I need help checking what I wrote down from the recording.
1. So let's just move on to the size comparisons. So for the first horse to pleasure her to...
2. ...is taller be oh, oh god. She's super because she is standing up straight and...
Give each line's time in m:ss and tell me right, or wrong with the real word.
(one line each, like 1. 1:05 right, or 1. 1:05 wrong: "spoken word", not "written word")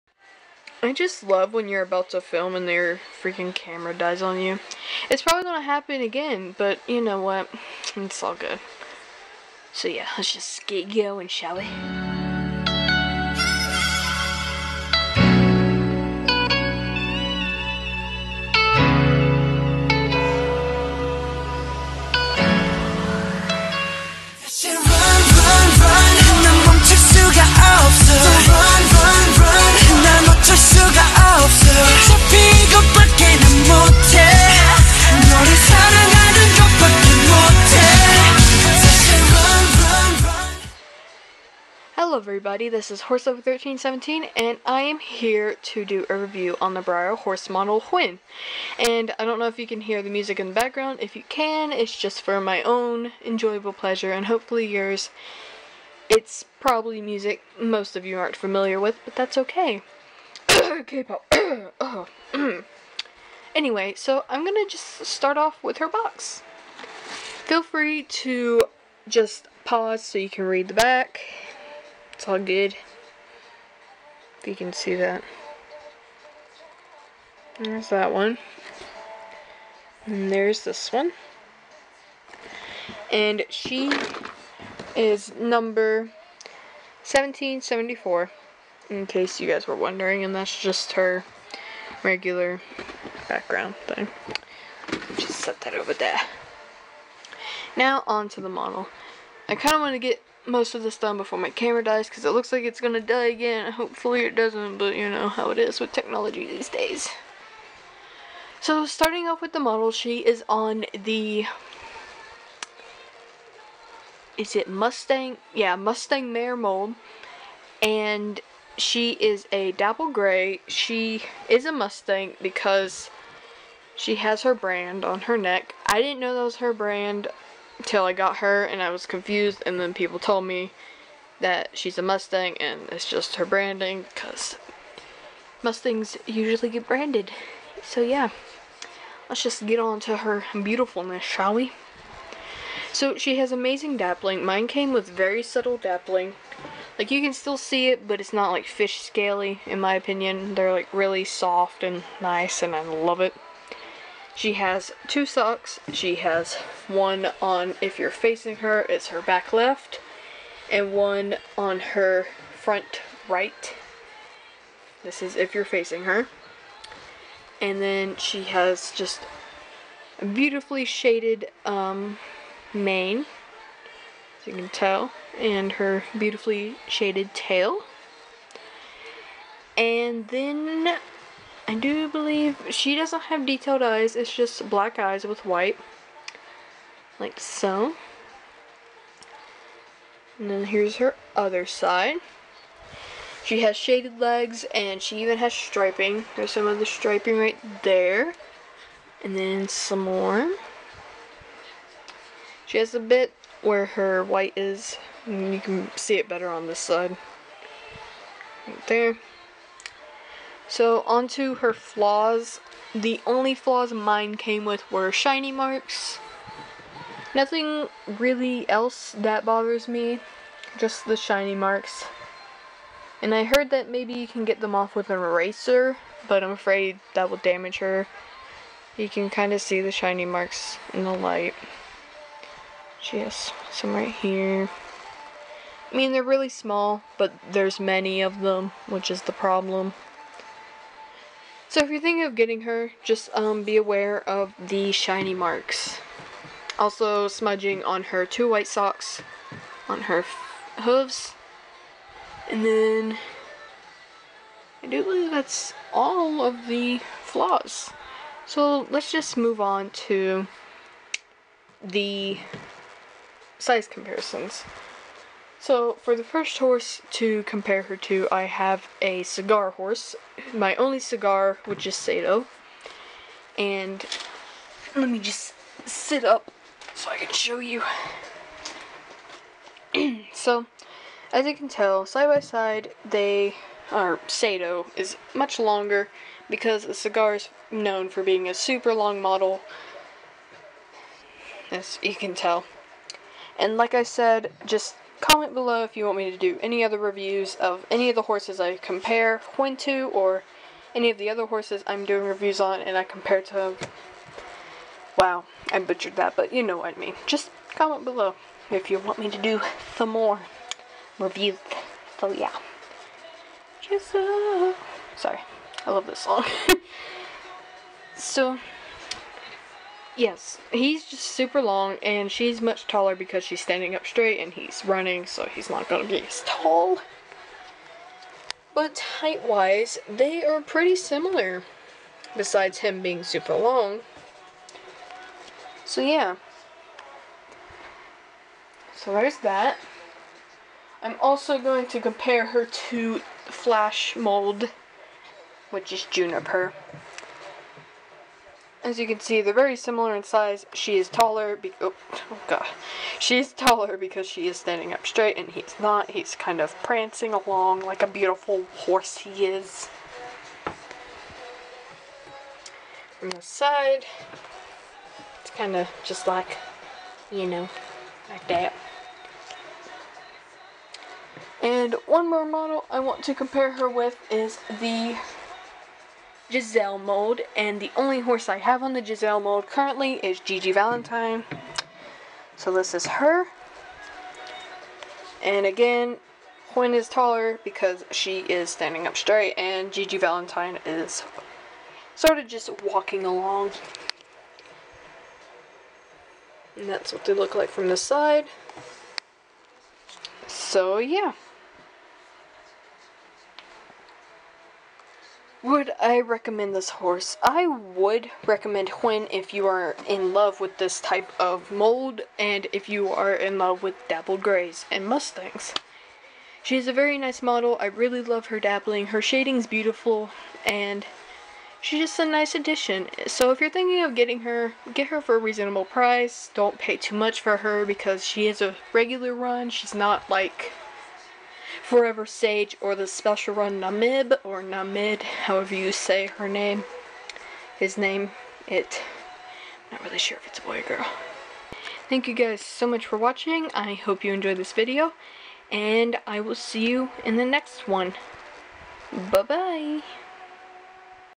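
1. 4:18 wrong: "compare", not "pleasure"
2. 5:50 wrong: "taller", not "super".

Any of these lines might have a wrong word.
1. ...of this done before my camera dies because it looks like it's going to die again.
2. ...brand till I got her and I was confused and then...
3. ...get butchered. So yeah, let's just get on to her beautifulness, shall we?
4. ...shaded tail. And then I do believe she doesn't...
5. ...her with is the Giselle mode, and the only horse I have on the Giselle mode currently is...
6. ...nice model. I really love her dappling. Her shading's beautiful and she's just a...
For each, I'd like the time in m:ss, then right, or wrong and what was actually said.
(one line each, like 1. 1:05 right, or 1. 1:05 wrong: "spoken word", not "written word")
1. 1:40 right
2. 2:06 right
3. 2:16 wrong: "branded", not "butchered"
4. 2:56 right
5. 6:13 right
6. 6:57 right.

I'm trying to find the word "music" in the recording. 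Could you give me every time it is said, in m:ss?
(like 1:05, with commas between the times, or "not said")
0:50, 0:57.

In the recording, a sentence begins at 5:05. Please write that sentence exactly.
Wow, I butchered that, but you know what I mean.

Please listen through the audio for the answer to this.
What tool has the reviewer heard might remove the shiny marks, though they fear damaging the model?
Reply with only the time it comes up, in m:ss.
3:45.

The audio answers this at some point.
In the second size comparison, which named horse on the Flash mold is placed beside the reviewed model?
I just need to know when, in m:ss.
5:46.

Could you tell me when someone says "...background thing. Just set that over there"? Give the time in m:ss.
1:33.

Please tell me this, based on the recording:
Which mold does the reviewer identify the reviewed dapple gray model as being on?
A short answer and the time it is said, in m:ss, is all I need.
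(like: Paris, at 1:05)
Mustang Mare, at 1:55.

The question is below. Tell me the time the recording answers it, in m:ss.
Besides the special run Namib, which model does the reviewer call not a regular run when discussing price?
7:11.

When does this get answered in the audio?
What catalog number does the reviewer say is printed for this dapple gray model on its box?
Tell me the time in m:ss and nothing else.
1:27.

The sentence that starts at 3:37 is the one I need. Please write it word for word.
Nothing really else that bothers me, just the shiny marks.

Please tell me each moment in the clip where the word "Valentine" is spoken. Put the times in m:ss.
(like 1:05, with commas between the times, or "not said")
6:20, 6:30.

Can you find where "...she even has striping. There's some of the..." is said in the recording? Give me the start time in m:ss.
3:15.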